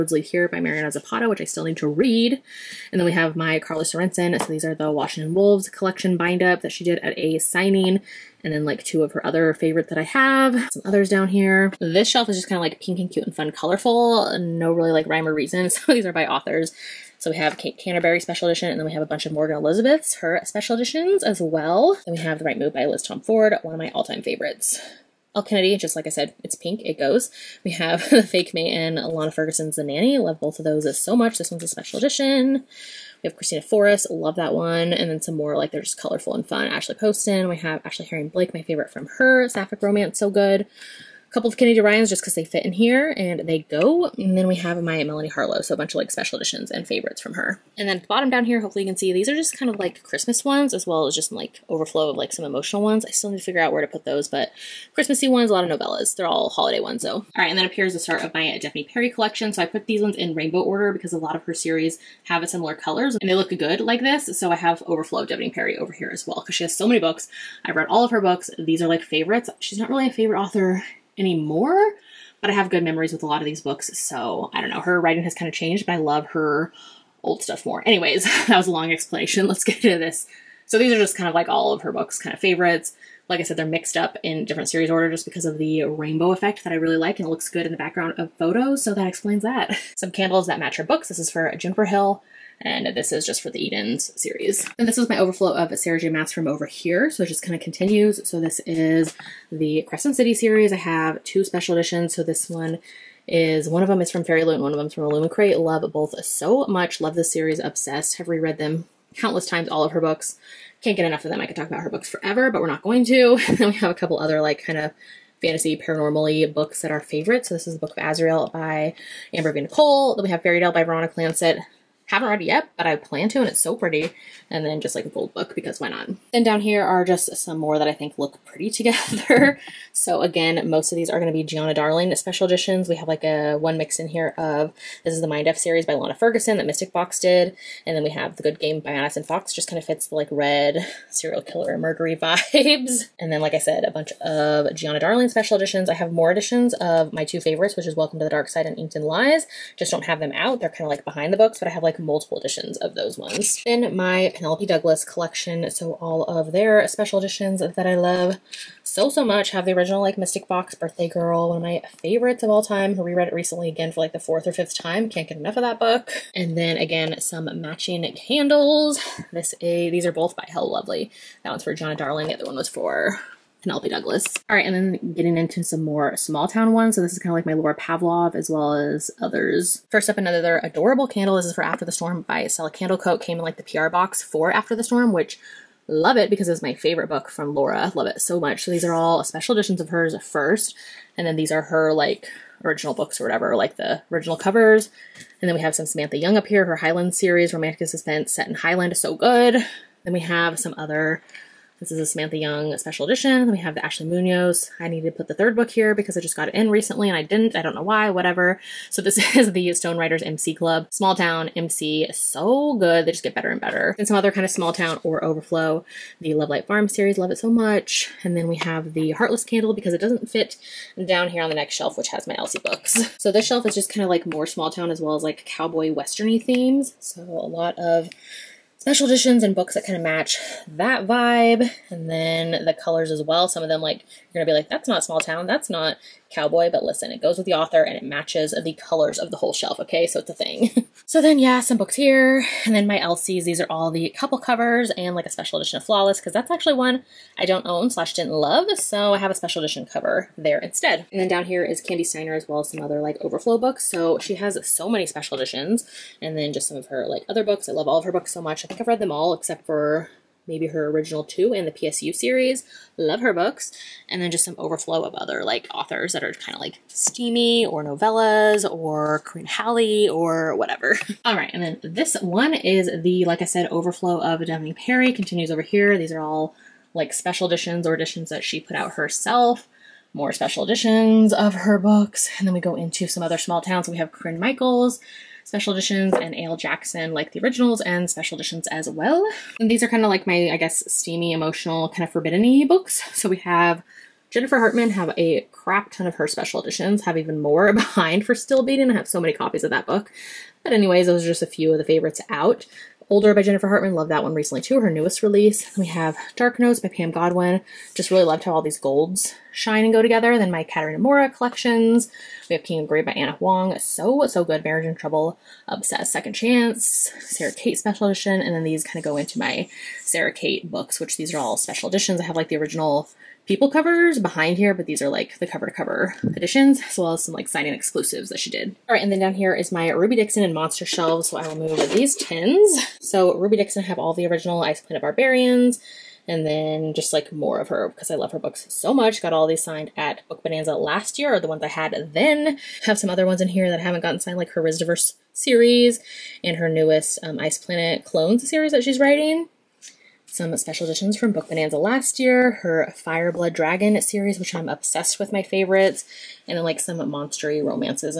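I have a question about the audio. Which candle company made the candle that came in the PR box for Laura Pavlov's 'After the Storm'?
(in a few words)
Stella Candle Co.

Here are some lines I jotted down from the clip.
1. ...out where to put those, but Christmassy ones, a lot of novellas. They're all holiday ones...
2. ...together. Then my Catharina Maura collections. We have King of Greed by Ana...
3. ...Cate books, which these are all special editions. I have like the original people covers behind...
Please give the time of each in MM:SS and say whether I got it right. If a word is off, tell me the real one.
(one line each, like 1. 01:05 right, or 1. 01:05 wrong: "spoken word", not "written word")
1. 00:53 right
2. 05:10 right
3. 05:20 right.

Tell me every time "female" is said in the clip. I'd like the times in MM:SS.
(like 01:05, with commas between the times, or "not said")
not said.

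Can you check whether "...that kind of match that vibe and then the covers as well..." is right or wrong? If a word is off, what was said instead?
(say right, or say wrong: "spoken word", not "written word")
wrong: "colors", not "covers".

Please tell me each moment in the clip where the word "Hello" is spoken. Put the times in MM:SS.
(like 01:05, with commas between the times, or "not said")
02:50.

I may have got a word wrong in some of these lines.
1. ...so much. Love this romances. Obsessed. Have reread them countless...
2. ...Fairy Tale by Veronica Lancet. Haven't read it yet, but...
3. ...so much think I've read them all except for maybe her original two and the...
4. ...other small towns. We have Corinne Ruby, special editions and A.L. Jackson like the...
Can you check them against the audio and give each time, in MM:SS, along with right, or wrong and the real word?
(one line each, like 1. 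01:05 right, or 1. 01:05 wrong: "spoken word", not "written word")
1. 01:46 wrong: "series", not "romances"
2. 02:00 right
3. 04:18 right
4. 04:43 wrong: "Michaels", not "Ruby".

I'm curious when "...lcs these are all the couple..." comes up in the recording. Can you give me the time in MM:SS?
04:02.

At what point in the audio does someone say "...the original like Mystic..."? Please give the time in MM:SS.
02:39.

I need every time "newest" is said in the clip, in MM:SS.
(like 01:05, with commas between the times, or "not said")
05:04, 05:46.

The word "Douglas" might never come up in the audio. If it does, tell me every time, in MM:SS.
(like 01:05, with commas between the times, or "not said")
02:34, 02:53.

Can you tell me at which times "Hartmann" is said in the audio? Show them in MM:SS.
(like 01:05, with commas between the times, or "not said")
04:54, 05:03.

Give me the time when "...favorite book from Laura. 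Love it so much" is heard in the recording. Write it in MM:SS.
03:06.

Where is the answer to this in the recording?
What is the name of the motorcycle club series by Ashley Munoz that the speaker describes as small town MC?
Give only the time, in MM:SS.
03:29.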